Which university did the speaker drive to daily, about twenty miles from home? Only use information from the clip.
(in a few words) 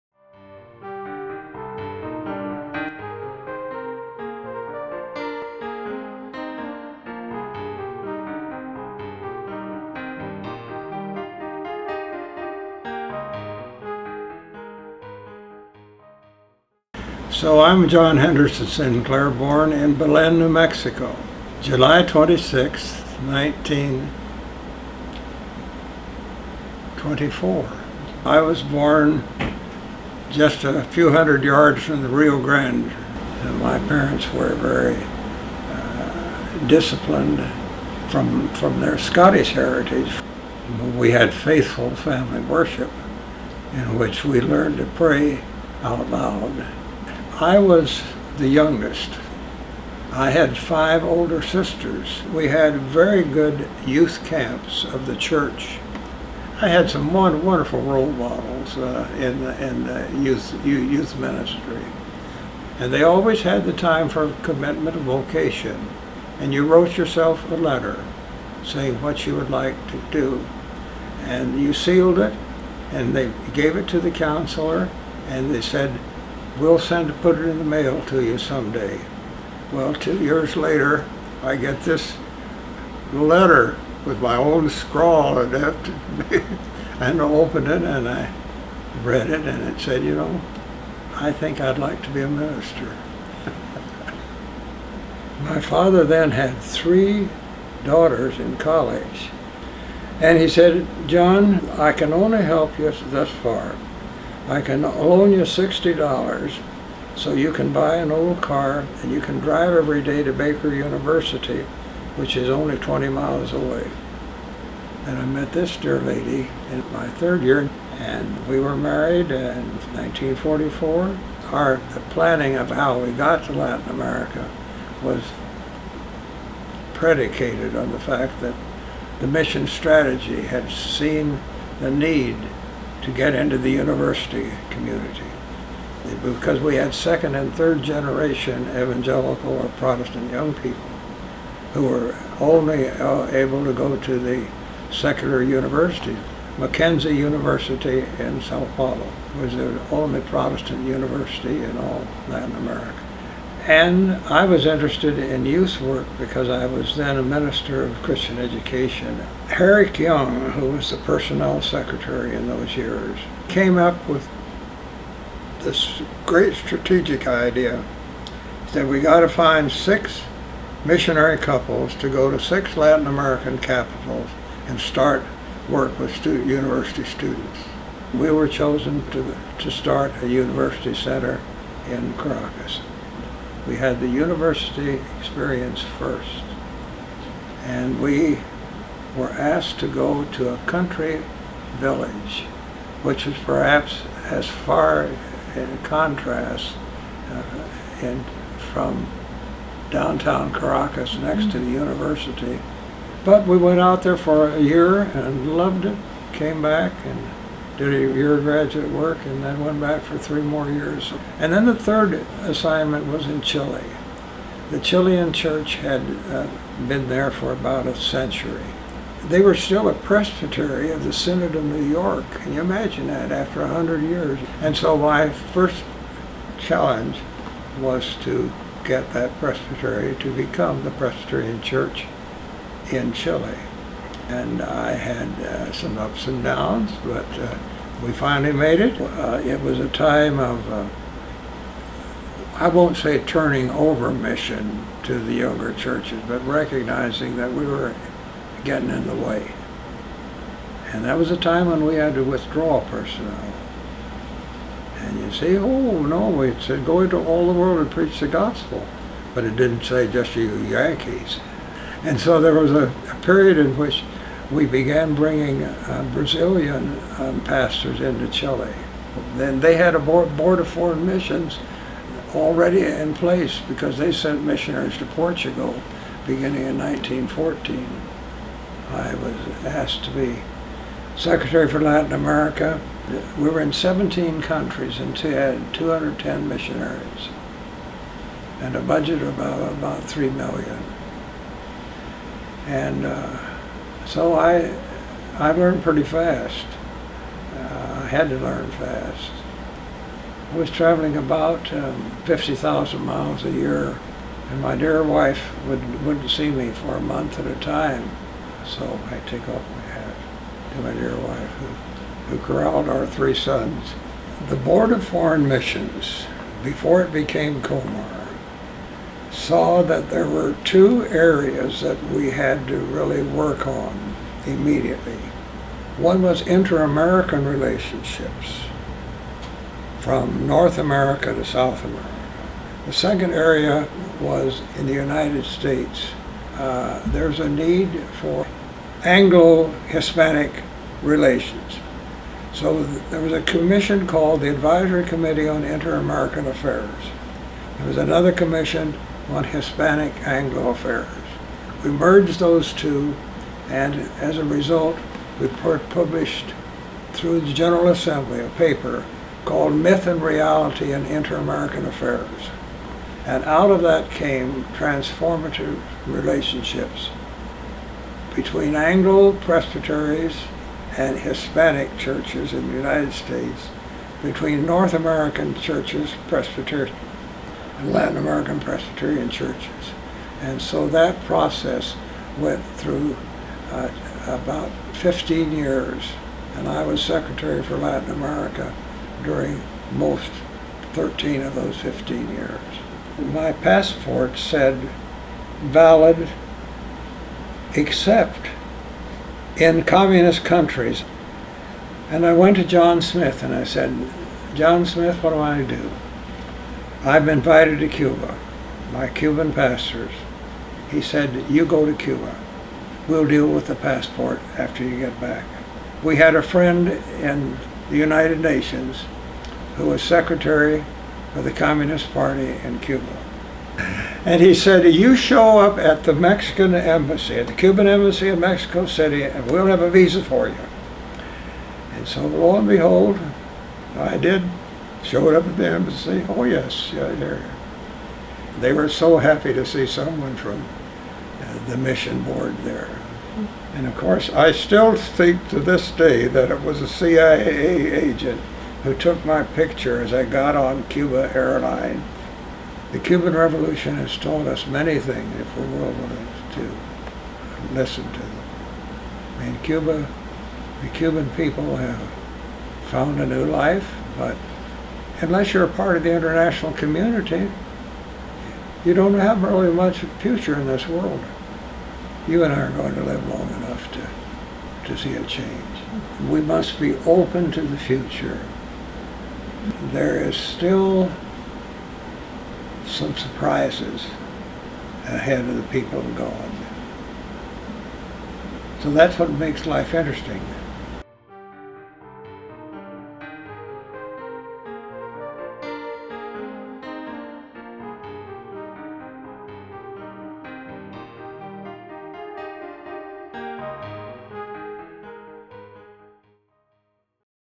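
Baker University.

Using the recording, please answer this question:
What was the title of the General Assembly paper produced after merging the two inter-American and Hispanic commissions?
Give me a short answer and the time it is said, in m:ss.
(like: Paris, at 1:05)
Myth and Reality in Inter-American Affairs, at 5:59.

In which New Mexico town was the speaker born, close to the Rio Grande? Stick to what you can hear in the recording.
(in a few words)
Belen.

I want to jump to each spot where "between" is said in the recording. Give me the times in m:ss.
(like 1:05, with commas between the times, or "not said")
6:08, 6:14.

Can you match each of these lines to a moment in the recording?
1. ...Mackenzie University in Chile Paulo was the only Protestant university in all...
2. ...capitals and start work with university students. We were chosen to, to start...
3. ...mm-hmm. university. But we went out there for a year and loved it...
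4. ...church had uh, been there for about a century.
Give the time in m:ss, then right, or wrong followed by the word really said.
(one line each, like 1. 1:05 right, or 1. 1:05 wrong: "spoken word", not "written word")
1. 2:26 wrong: "Sao", not "Chile"
2. 2:53 right
3. 3:21 right
4. 3:35 right.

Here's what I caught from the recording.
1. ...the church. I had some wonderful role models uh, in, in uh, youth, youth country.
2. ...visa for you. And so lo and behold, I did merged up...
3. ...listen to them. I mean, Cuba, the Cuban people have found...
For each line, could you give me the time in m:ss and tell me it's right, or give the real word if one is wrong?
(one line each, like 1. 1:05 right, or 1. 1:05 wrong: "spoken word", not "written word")
1. 0:55 wrong: "ministry", not "country"
2. 7:09 wrong: "showed", not "merged"
3. 7:37 right.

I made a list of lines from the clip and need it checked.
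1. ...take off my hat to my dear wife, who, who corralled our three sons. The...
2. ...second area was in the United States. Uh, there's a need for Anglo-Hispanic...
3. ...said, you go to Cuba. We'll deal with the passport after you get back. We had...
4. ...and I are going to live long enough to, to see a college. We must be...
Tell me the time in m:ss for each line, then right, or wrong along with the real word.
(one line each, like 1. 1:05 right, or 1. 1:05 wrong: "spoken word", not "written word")
1. 5:09 right
2. 5:32 right
3. 6:51 right
4. 7:52 wrong: "change", not "college".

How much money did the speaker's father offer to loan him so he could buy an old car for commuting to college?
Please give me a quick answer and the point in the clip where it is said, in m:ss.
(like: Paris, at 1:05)
$60, at 1:45.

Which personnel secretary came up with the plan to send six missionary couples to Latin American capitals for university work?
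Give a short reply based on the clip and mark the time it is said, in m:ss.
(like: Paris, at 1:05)
Herrick Young, at 2:39.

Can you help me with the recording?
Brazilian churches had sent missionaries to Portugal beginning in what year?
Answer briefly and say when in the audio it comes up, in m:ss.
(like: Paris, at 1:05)
1914, at 4:36.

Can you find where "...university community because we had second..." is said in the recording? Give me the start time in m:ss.
2:13.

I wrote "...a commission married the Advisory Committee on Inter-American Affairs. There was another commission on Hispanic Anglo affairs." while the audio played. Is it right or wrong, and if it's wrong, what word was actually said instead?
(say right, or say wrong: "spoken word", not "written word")
wrong: "called", not "married".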